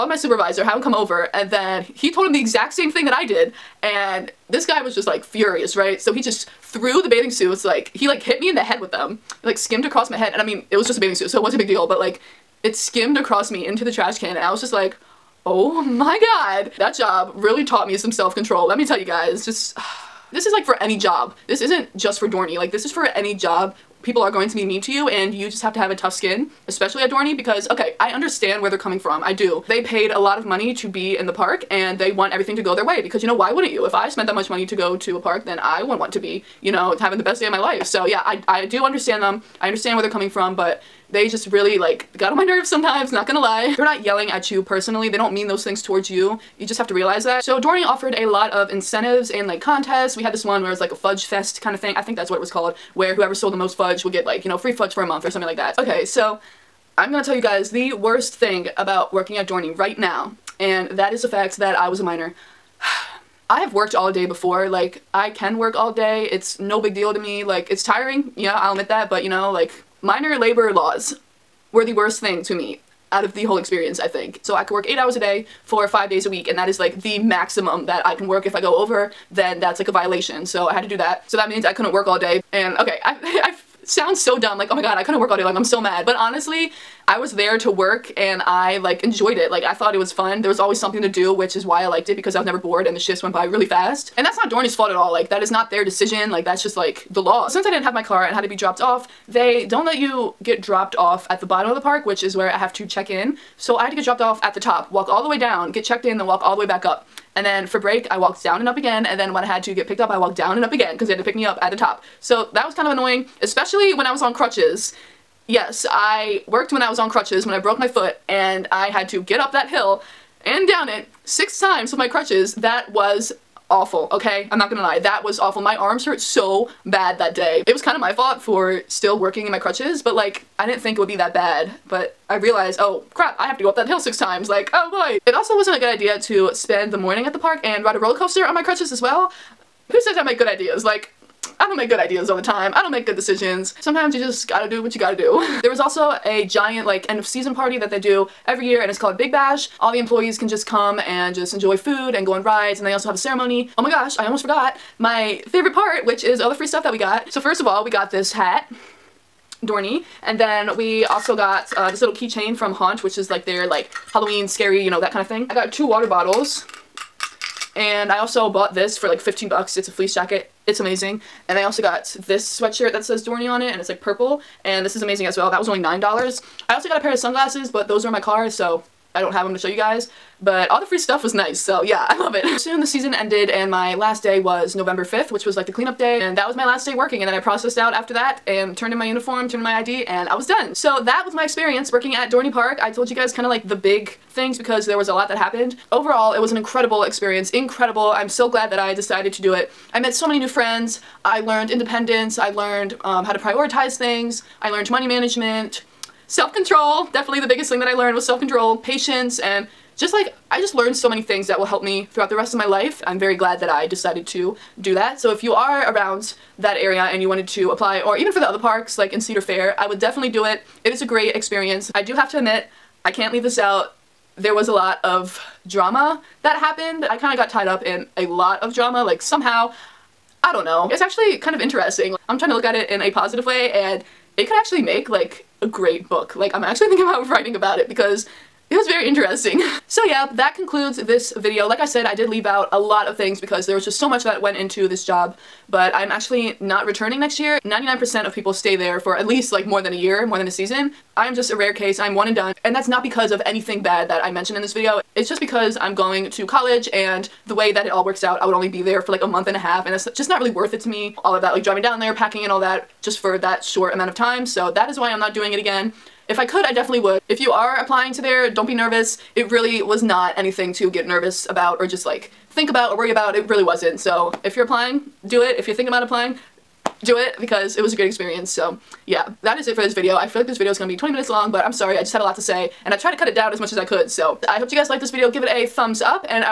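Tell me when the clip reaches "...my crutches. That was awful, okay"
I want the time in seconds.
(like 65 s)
121 s.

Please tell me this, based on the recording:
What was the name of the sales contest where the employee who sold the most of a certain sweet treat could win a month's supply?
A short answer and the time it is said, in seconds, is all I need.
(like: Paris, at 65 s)
Fudge fest, at 50 s.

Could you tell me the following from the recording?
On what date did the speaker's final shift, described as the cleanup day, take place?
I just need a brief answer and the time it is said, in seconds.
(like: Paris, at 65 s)
November 5th, at 184 s.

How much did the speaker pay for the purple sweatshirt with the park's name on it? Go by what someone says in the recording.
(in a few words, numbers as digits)
$9.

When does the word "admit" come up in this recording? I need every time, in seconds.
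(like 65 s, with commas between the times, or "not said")
68 s, 222 s.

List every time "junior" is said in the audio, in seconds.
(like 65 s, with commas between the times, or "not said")
not said.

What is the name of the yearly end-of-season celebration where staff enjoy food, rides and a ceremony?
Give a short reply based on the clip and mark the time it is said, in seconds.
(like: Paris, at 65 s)
Big Bash, at 149 s.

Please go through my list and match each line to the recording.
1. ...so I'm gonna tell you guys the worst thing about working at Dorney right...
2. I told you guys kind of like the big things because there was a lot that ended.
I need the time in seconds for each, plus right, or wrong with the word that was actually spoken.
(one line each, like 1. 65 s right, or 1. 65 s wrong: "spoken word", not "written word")
1. 56 s right
2. 192 s wrong: "happened", not "ended".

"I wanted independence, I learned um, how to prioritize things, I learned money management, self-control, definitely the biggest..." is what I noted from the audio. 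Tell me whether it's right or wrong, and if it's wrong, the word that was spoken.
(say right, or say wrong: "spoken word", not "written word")
wrong: "learned", not "wanted".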